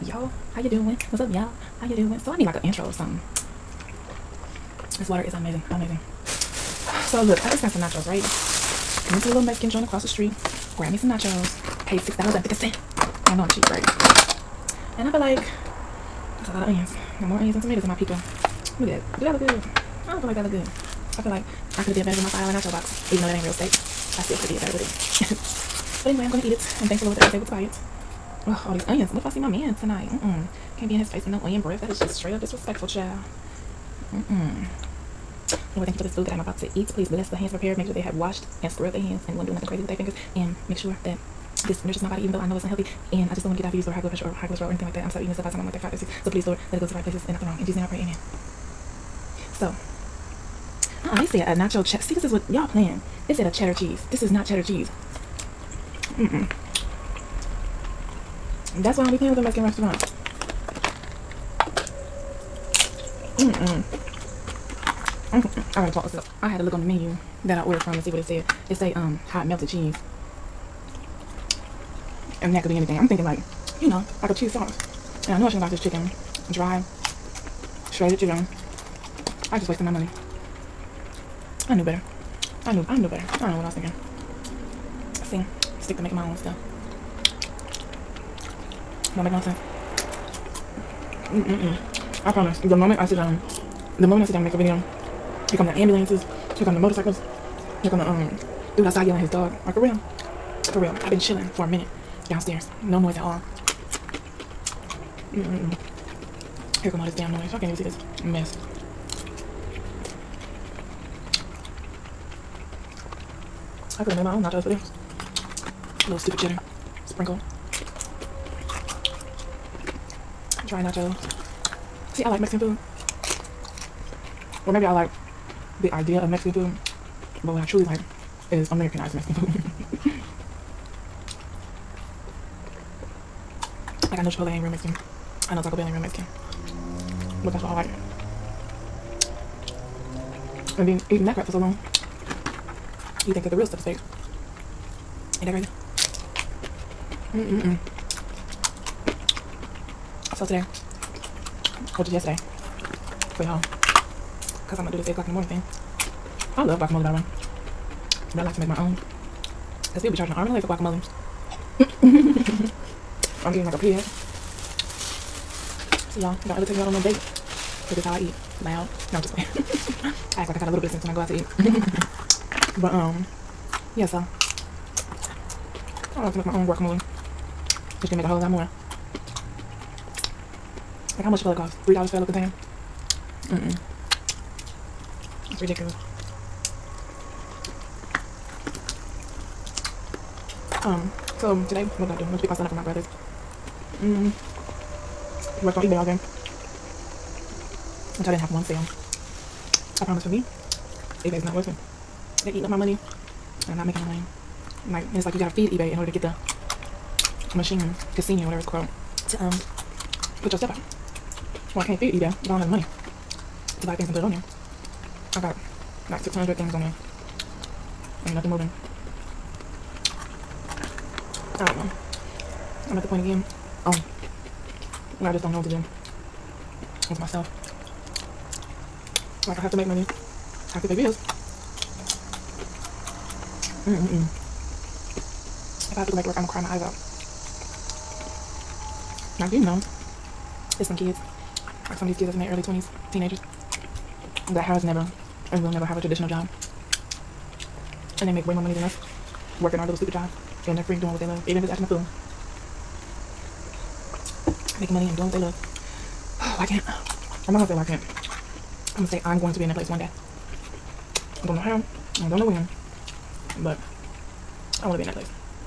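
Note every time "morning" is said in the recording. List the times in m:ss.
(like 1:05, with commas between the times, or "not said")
2:35.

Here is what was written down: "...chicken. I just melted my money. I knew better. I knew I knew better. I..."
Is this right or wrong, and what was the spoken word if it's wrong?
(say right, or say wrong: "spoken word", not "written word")
wrong: "wasted", not "melted".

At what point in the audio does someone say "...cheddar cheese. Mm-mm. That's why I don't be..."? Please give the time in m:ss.
0:54.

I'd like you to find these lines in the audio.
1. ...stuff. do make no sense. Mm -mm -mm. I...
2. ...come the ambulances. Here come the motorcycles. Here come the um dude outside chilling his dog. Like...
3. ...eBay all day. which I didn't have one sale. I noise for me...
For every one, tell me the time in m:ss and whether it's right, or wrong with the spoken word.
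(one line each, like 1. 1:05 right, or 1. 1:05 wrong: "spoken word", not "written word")
1. 1:26 right
2. 1:35 wrong: "yelling", not "chilling"
3. 3:15 wrong: "promise", not "noise".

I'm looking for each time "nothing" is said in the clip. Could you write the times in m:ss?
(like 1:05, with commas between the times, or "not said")
0:39, 3:38.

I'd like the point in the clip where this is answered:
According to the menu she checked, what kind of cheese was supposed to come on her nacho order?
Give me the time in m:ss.
1:09.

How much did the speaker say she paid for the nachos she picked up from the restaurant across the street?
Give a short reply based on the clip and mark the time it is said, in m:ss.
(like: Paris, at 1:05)
$6.50, at 0:11.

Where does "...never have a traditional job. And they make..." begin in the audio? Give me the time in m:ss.
4:05.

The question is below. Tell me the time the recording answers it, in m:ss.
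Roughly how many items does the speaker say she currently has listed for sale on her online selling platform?
3:36.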